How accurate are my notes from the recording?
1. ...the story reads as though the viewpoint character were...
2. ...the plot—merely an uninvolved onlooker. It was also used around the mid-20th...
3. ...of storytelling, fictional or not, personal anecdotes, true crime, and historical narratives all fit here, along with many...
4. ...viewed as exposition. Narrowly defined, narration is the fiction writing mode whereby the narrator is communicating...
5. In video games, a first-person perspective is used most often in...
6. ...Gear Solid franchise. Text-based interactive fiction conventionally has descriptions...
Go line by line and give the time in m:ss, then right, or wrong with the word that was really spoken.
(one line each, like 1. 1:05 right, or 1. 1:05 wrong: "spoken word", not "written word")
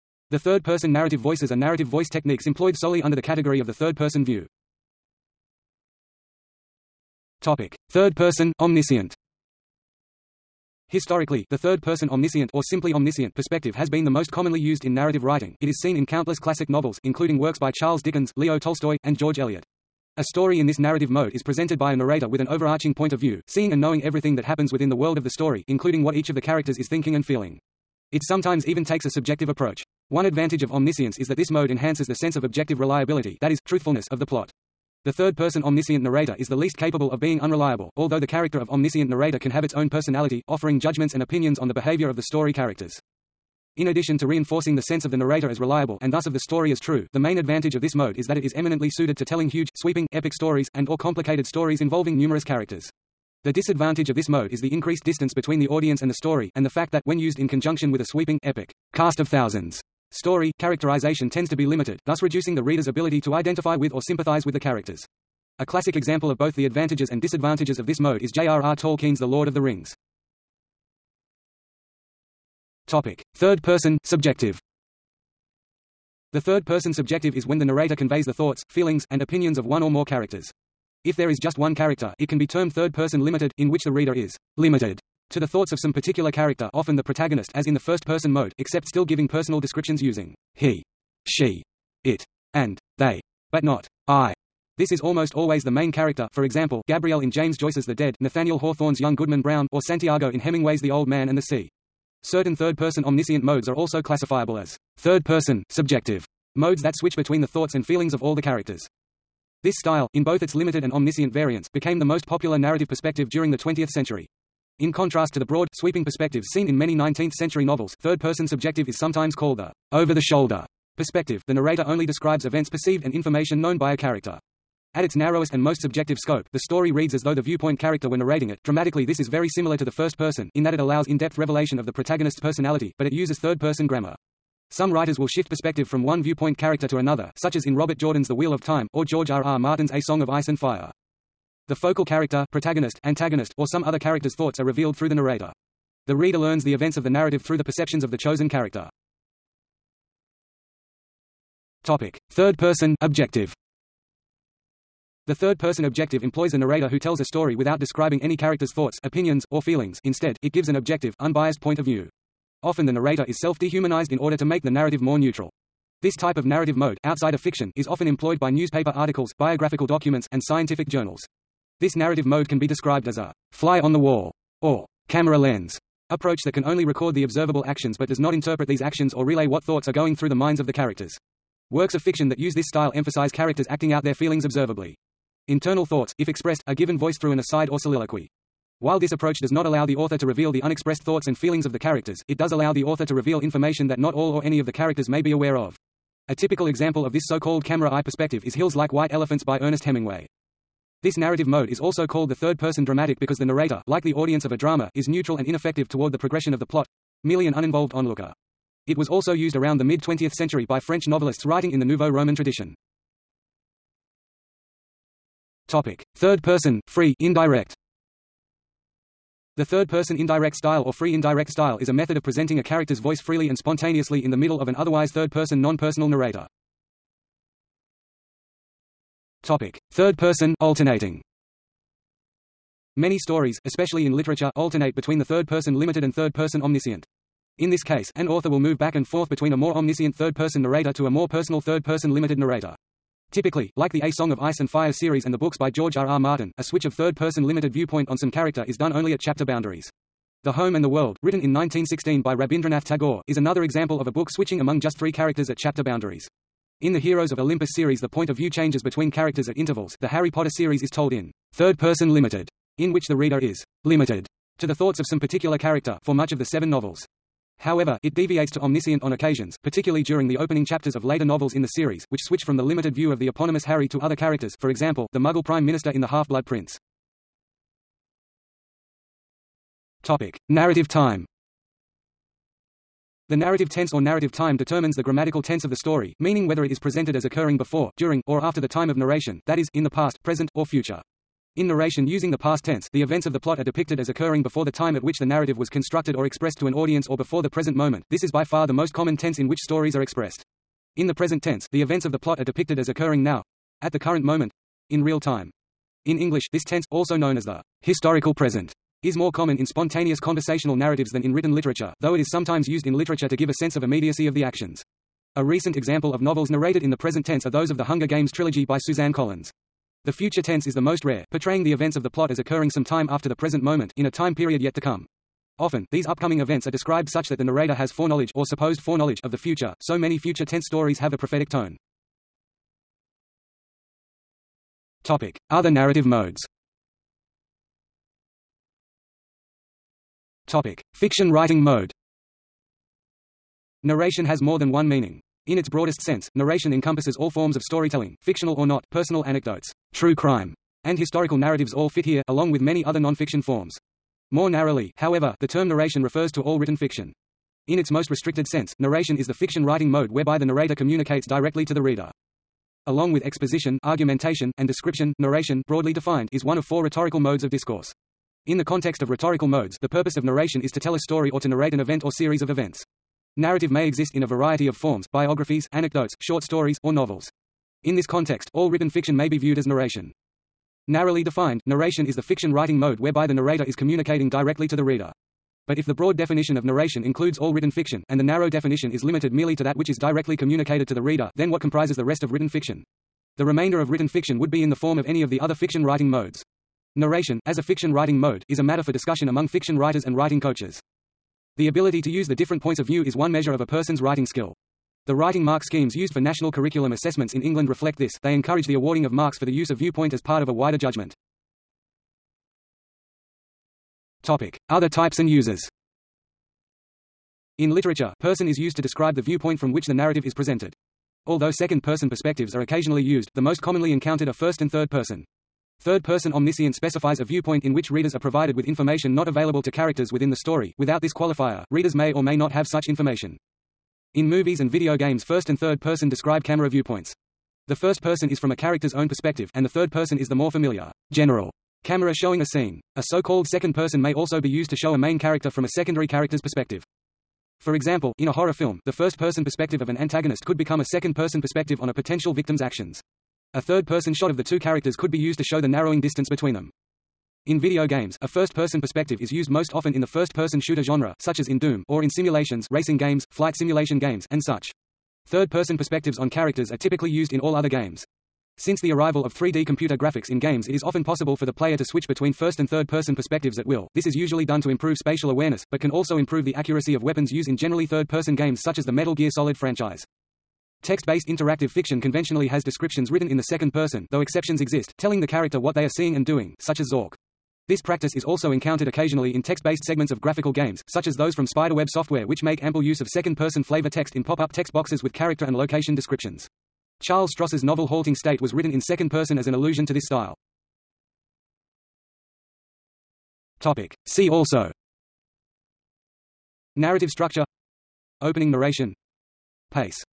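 1. 2:06 right
2. 3:26 right
3. 5:47 right
4. 6:19 wrong: "narration", not "exposition"
5. 7:37 right
6. 7:59 right.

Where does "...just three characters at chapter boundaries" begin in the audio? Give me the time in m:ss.
4:14.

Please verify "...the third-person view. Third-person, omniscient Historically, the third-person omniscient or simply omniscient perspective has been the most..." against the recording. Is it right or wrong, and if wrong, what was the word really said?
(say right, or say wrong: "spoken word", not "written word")
right.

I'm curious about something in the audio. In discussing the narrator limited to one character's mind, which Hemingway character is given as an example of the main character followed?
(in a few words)
Santiago.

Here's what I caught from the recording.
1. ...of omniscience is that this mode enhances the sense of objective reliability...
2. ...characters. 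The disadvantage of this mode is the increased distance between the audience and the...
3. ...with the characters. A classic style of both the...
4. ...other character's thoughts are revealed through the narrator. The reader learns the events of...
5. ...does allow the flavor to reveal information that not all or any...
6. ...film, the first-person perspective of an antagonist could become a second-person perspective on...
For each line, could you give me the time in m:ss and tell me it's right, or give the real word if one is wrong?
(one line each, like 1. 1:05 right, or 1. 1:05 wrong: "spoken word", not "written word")
1. 0:30 right
2. 0:52 right
3. 1:04 wrong: "example", not "style"
4. 2:23 right
5. 3:12 wrong: "author", not "flavor"
6. 7:28 right.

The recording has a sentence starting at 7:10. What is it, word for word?
Without this qualifier, readers may or may not have such information.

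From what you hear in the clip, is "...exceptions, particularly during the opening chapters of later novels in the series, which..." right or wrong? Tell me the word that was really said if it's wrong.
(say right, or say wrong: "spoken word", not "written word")
wrong: "occasions", not "exceptions".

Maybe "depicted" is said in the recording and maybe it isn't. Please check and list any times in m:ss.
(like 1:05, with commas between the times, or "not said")
4:53, 5:02.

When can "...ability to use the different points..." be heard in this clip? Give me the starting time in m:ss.
6:41.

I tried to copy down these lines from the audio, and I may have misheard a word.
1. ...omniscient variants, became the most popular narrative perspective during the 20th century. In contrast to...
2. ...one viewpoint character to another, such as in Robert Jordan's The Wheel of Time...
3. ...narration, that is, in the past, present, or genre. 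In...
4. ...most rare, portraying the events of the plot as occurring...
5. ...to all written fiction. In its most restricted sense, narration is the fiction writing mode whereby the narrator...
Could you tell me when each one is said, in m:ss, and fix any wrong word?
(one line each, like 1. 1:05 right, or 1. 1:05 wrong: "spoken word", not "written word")
1. 1:50 right
2. 2:16 right
3. 4:48 wrong: "future", not "genre"
4. 5:20 right
5. 5:56 right.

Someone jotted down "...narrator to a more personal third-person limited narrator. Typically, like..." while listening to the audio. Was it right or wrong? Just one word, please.
right.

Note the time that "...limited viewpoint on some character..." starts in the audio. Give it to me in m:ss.
4:07.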